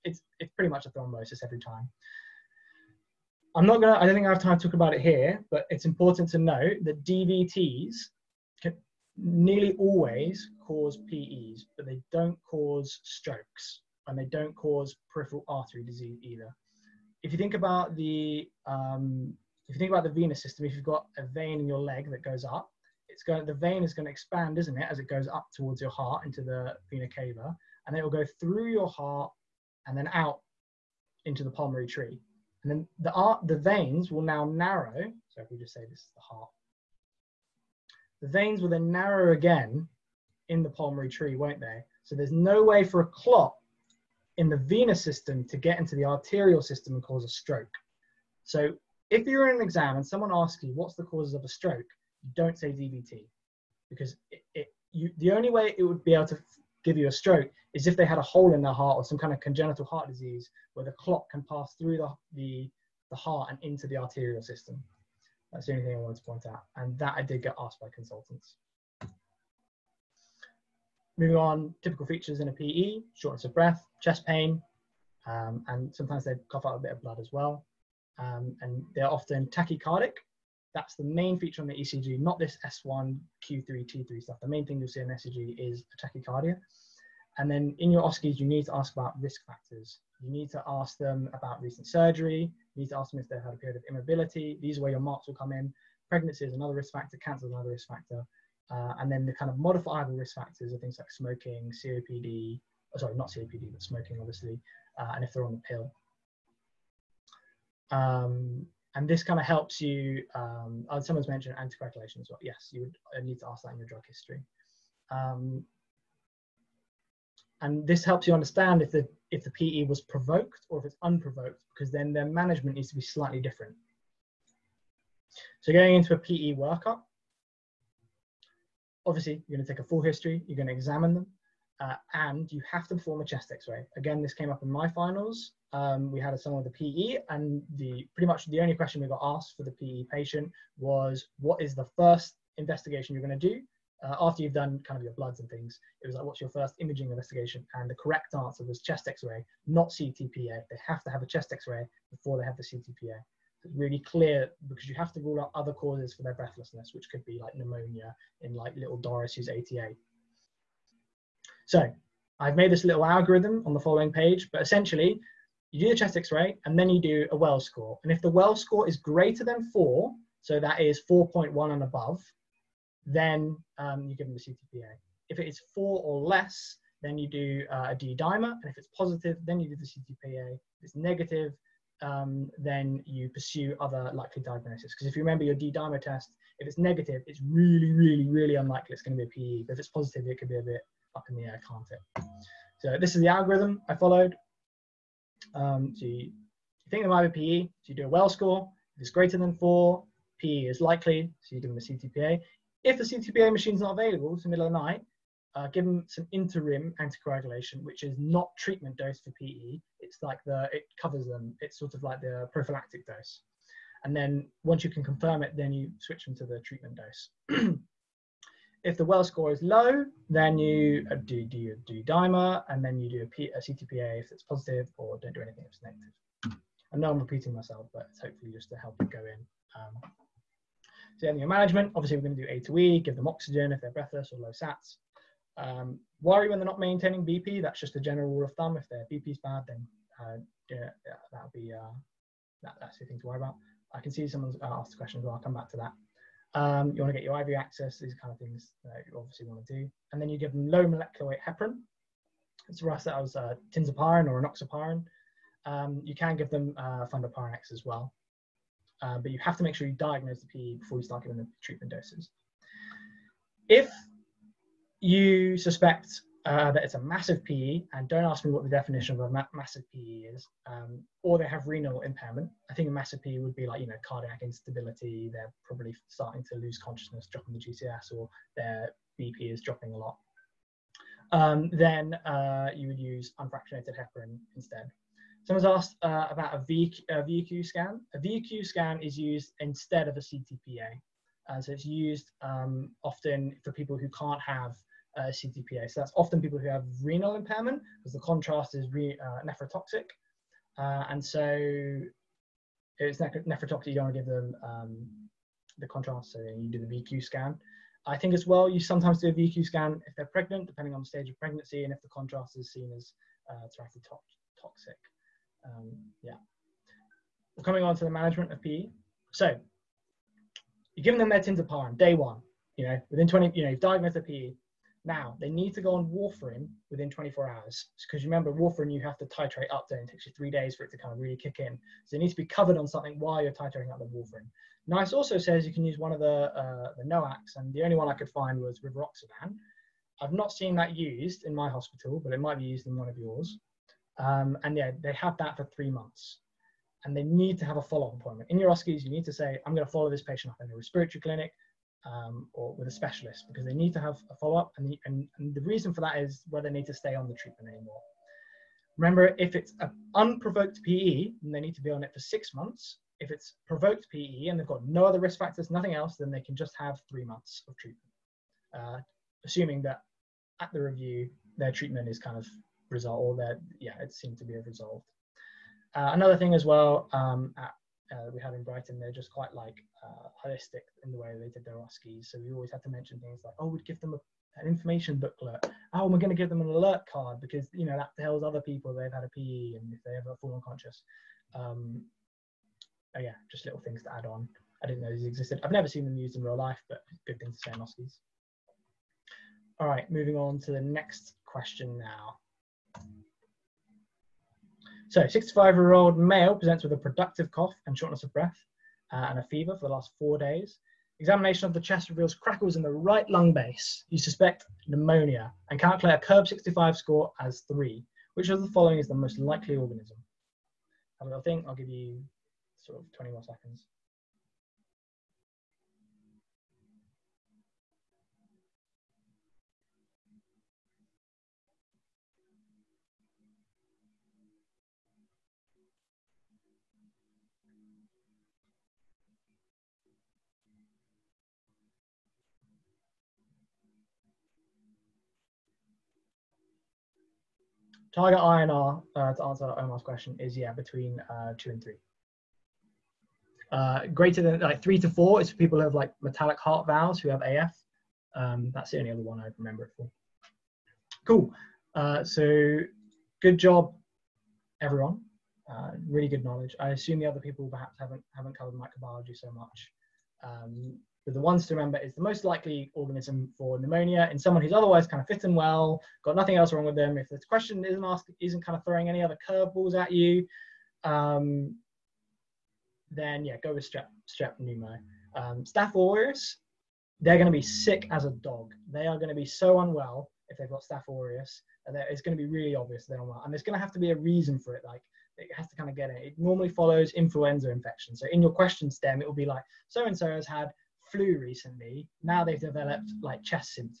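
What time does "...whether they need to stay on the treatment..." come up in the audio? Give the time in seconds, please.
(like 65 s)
356 s.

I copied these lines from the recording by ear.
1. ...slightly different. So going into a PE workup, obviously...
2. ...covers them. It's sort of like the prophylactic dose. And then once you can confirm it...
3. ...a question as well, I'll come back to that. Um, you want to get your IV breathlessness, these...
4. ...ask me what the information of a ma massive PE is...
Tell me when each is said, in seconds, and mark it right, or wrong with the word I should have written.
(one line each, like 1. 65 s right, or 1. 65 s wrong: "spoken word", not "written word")
1. 123 s right
2. 211 s right
3. 244 s wrong: "access", not "breathlessness"
4. 268 s wrong: "definition", not "information".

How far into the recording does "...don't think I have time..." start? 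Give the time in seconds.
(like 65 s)
4 s.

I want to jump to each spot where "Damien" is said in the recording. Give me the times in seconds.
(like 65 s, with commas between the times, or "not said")
not said.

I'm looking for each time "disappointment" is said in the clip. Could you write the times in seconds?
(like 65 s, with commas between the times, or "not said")
not said.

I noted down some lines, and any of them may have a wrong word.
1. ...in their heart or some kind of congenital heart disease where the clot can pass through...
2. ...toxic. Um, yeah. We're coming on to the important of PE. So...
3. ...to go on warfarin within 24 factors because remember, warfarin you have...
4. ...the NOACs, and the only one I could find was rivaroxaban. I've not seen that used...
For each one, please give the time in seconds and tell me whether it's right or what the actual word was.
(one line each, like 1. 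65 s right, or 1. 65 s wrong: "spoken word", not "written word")
1. 58 s right
2. 313 s wrong: "management", not "important"
3. 325 s wrong: "hours", not "factors"
4. 336 s right.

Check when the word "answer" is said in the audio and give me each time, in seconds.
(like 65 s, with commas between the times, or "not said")
148 s, 449 s.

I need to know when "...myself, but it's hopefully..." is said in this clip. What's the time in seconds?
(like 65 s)
227 s.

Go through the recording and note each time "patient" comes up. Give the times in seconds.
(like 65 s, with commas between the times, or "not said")
140 s, 350 s.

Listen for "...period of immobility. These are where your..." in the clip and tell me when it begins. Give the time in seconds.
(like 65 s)
93 s.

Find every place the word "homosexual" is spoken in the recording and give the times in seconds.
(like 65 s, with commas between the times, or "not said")
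not said.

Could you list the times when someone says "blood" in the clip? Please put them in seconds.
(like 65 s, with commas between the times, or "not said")
77 s, 145 s.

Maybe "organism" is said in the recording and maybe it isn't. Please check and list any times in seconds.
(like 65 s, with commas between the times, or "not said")
419 s, 472 s.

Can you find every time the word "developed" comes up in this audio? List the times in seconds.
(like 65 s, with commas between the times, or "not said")
502 s.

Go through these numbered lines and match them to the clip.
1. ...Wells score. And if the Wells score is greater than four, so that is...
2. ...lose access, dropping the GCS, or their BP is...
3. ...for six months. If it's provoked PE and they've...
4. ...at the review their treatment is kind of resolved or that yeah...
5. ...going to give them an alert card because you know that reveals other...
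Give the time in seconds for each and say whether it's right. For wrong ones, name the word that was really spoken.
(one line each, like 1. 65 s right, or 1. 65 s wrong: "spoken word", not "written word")
1. 167 s right
2. 276 s wrong: "consciousness", not "access"
3. 362 s right
4. 370 s right
5. 386 s wrong: "tells", not "reveals".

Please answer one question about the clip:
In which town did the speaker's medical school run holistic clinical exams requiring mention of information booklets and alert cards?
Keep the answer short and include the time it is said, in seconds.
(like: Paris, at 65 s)
Brighton, at 378 s.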